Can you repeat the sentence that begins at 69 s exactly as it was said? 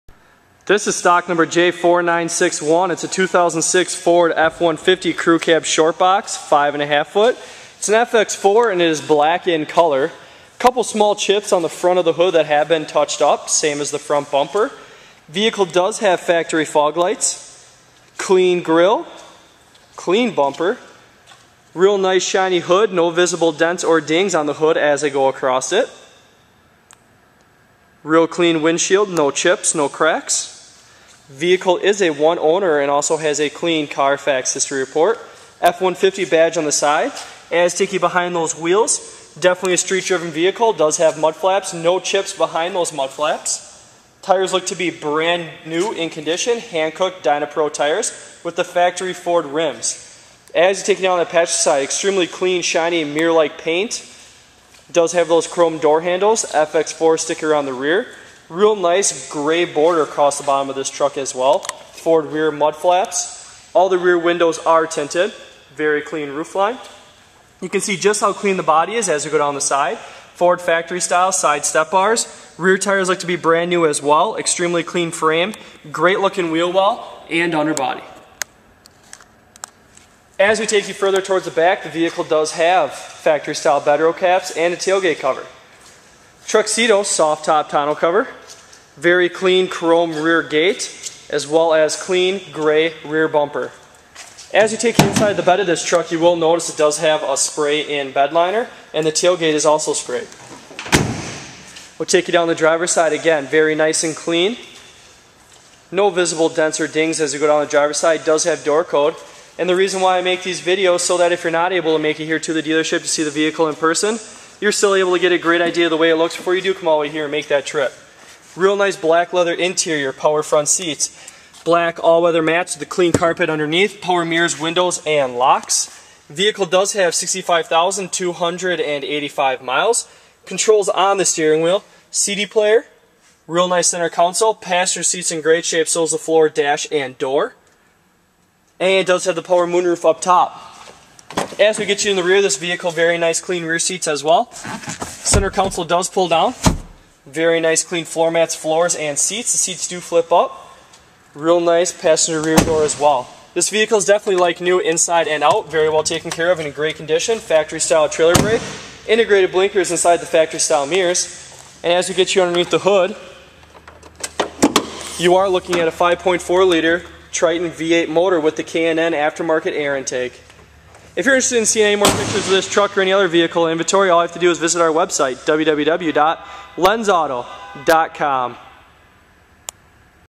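Ford factory style side step bars.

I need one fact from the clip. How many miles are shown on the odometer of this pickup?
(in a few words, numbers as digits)
65,285.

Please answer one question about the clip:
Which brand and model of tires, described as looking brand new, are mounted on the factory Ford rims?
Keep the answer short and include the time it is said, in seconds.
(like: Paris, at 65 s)
Hankook Dynapro, at 46 s.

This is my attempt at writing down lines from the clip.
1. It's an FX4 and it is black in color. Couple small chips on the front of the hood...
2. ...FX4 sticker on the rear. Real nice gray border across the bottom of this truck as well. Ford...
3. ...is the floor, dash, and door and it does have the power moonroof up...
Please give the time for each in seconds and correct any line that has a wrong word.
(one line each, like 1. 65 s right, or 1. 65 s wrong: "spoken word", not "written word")
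1. 7 s right
2. 56 s right
3. 136 s right.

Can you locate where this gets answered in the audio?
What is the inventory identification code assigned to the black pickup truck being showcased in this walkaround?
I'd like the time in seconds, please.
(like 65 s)
1 s.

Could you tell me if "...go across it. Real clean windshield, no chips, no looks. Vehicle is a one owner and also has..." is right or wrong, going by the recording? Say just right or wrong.
wrong.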